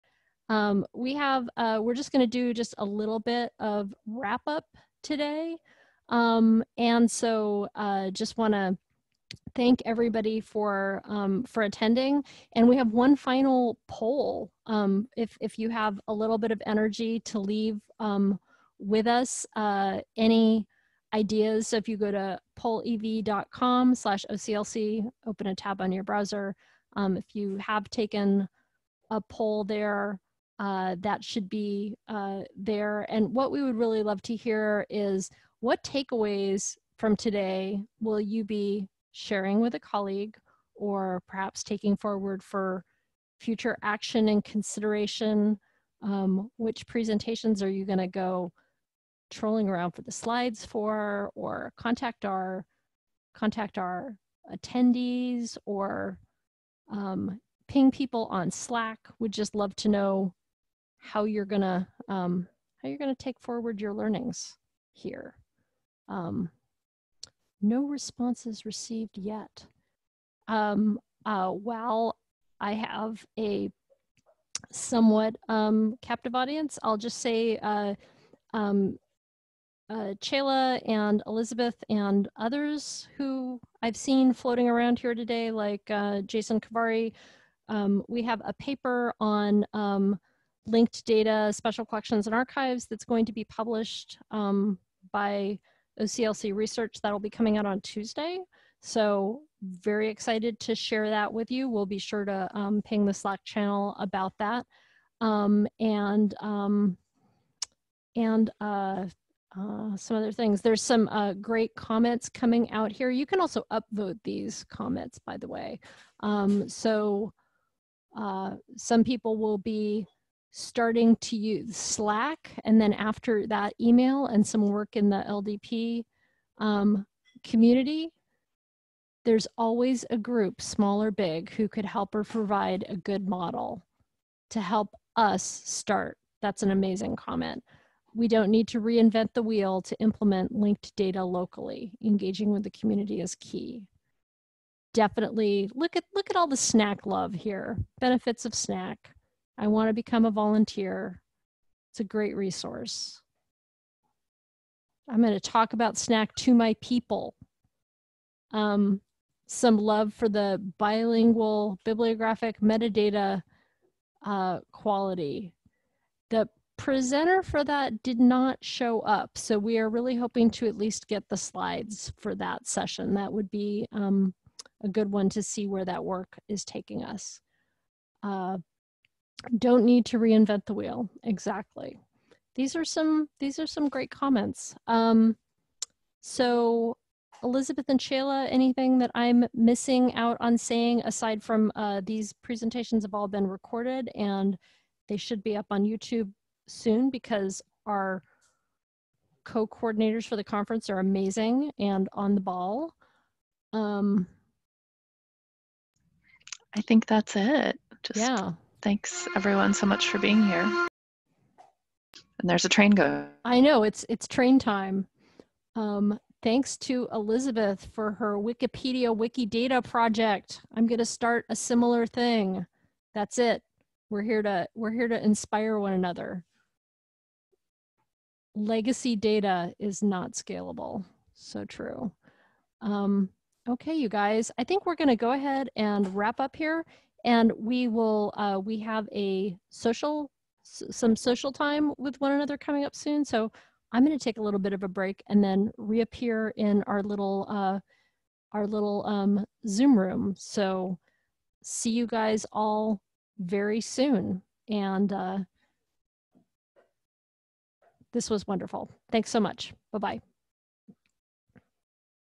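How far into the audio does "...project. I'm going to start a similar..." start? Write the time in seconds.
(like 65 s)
219 s.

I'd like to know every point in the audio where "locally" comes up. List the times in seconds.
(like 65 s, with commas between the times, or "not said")
141 s.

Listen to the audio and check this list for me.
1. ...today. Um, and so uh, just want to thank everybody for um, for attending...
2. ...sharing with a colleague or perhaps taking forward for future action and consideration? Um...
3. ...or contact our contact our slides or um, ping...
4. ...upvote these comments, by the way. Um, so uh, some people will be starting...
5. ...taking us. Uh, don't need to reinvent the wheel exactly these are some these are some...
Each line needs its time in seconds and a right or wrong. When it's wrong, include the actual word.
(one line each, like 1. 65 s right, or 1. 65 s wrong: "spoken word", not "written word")
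1. 5 s right
2. 39 s right
3. 51 s wrong: "attendees", not "slides"
4. 113 s right
5. 176 s right.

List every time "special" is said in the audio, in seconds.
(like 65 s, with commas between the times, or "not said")
91 s.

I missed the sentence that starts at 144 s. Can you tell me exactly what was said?
Definitely look at look at all the SNAC love here.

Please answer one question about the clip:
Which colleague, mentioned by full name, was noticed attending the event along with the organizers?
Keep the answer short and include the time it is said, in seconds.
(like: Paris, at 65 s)
Jason Kovari, at 86 s.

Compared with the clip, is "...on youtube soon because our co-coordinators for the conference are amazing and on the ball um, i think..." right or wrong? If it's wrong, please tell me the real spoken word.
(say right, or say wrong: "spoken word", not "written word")
right.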